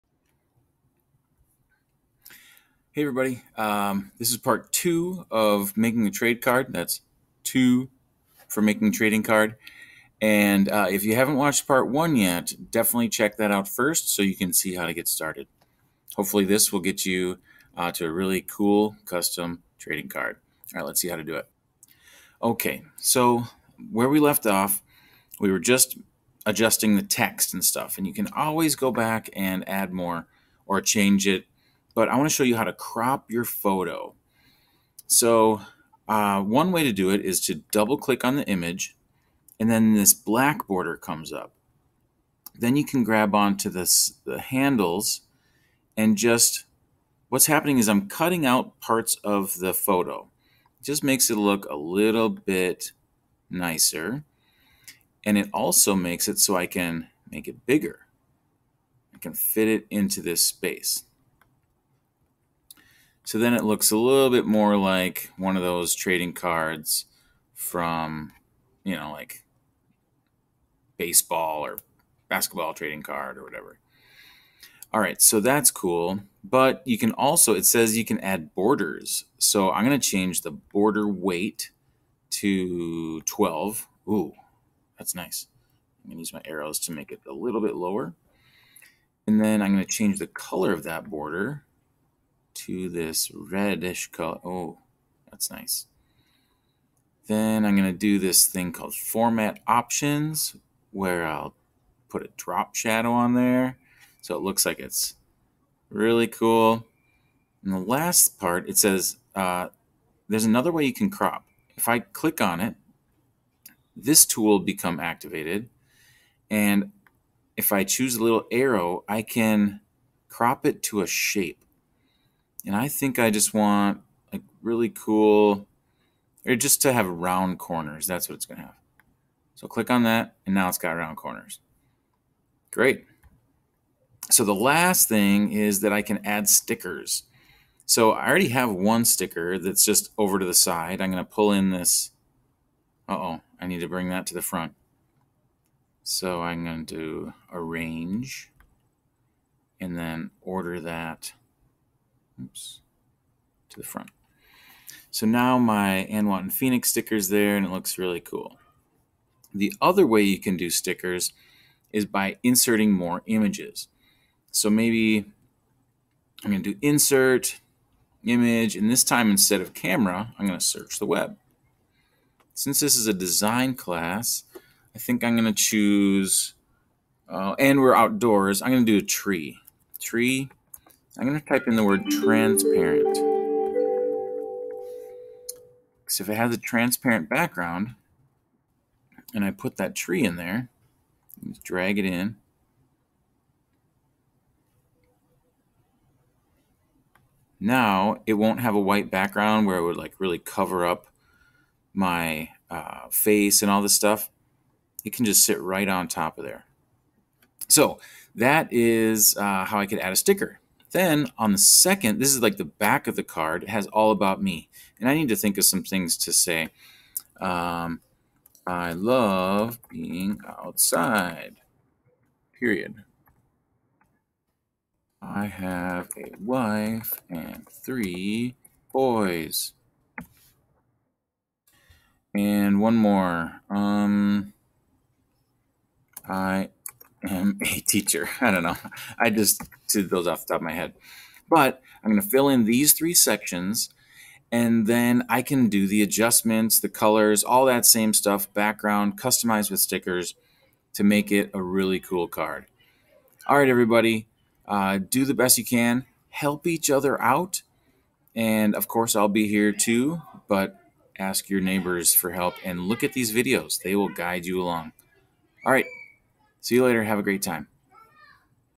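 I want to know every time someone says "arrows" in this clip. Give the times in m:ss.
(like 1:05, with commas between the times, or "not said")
1:26, 1:58.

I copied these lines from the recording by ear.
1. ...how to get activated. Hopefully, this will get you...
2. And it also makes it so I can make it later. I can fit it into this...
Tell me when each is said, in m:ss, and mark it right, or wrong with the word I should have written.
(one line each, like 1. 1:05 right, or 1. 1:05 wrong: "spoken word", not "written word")
1. 0:14 wrong: "started", not "activated"
2. 0:55 wrong: "bigger", not "later".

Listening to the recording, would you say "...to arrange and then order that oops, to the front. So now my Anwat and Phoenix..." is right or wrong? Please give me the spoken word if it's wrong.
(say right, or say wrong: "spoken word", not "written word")
right.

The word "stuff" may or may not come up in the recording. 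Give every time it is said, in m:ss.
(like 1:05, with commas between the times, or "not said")
0:27, 3:23, 4:08.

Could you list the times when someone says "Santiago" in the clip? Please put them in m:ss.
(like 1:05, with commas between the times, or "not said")
not said.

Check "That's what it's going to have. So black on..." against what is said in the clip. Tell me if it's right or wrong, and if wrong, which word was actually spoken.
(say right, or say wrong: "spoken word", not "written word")
wrong: "click", not "black".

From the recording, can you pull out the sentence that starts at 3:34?
And I need to think of some things to say.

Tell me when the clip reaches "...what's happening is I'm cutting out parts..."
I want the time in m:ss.
0:47.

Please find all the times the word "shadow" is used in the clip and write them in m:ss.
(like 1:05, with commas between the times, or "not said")
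1:42.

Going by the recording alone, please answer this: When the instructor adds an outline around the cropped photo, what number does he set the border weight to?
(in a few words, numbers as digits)
12.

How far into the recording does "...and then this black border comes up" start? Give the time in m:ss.
0:39.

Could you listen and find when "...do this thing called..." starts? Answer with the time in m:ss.
1:37.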